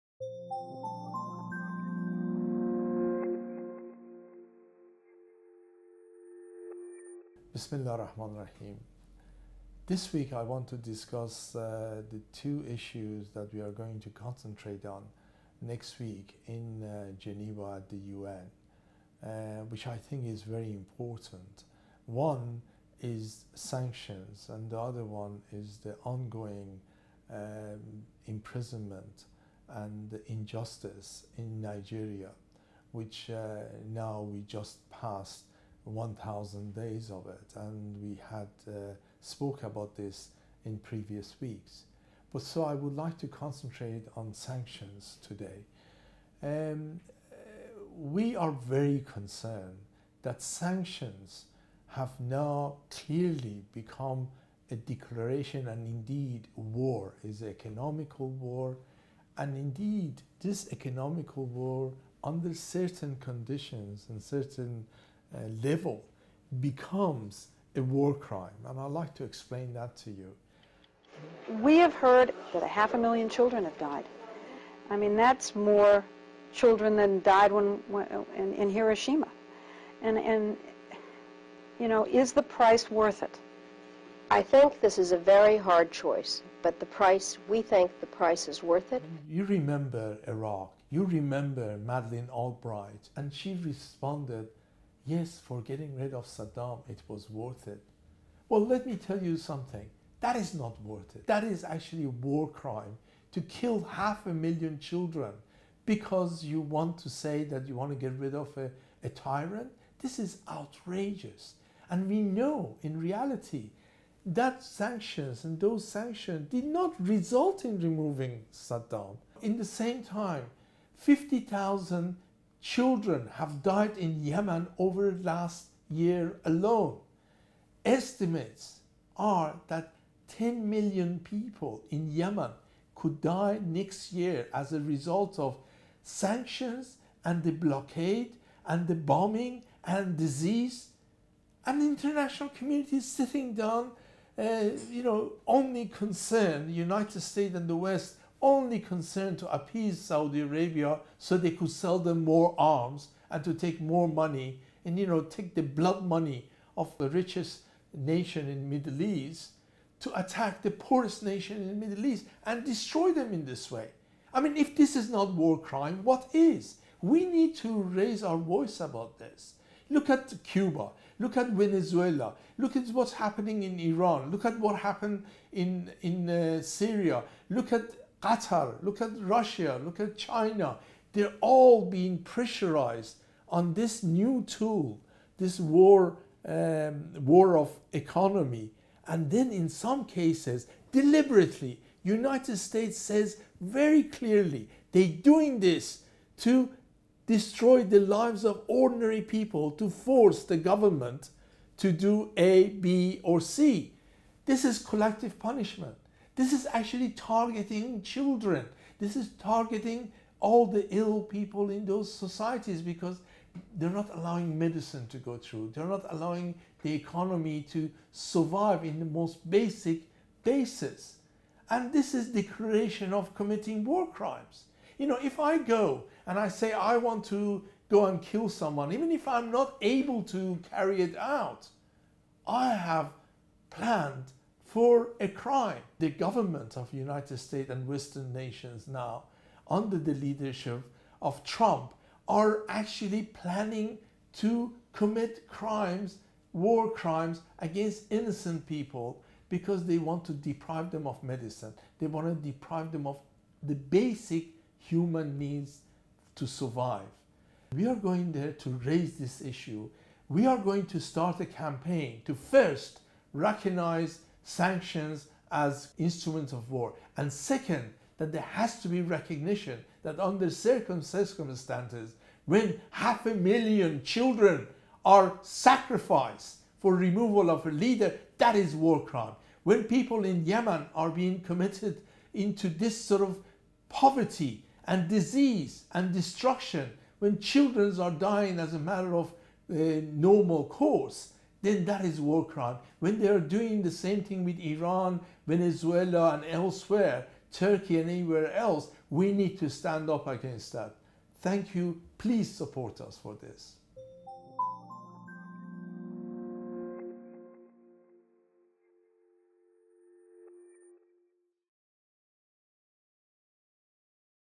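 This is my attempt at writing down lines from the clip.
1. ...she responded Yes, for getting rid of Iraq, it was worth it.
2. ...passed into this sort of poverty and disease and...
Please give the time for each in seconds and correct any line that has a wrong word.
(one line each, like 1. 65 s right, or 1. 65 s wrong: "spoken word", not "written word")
1. 93 s wrong: "Saddam", not "Iraq"
2. 281 s wrong: "committed", not "passed".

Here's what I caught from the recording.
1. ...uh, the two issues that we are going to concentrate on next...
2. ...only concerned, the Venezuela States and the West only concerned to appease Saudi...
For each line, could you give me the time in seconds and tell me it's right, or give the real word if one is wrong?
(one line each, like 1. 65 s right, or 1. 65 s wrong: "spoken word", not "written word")
1. 11 s right
2. 145 s wrong: "United", not "Venezuela".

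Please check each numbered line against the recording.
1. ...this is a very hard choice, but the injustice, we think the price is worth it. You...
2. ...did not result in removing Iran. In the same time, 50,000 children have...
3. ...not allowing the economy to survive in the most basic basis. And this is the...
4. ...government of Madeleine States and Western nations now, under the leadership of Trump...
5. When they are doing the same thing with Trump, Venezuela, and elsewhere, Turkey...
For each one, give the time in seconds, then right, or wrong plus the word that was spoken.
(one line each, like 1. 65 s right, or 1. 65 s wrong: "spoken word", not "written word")
1. 84 s wrong: "price", not "injustice"
2. 116 s wrong: "Saddam", not "Iran"
3. 215 s right
4. 236 s wrong: "United", not "Madeleine"
5. 292 s wrong: "Iran", not "Trump".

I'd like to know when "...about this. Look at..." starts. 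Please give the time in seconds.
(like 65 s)
168 s.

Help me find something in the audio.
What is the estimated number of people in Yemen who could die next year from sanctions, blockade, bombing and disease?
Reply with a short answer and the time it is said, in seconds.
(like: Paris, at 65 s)
10 million, at 130 s.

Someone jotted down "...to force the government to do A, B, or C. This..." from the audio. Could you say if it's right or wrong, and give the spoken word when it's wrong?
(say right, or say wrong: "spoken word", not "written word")
right.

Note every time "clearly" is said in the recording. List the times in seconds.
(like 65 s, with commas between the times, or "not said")
52 s, 194 s.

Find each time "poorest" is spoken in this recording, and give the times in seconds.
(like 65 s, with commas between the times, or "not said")
160 s.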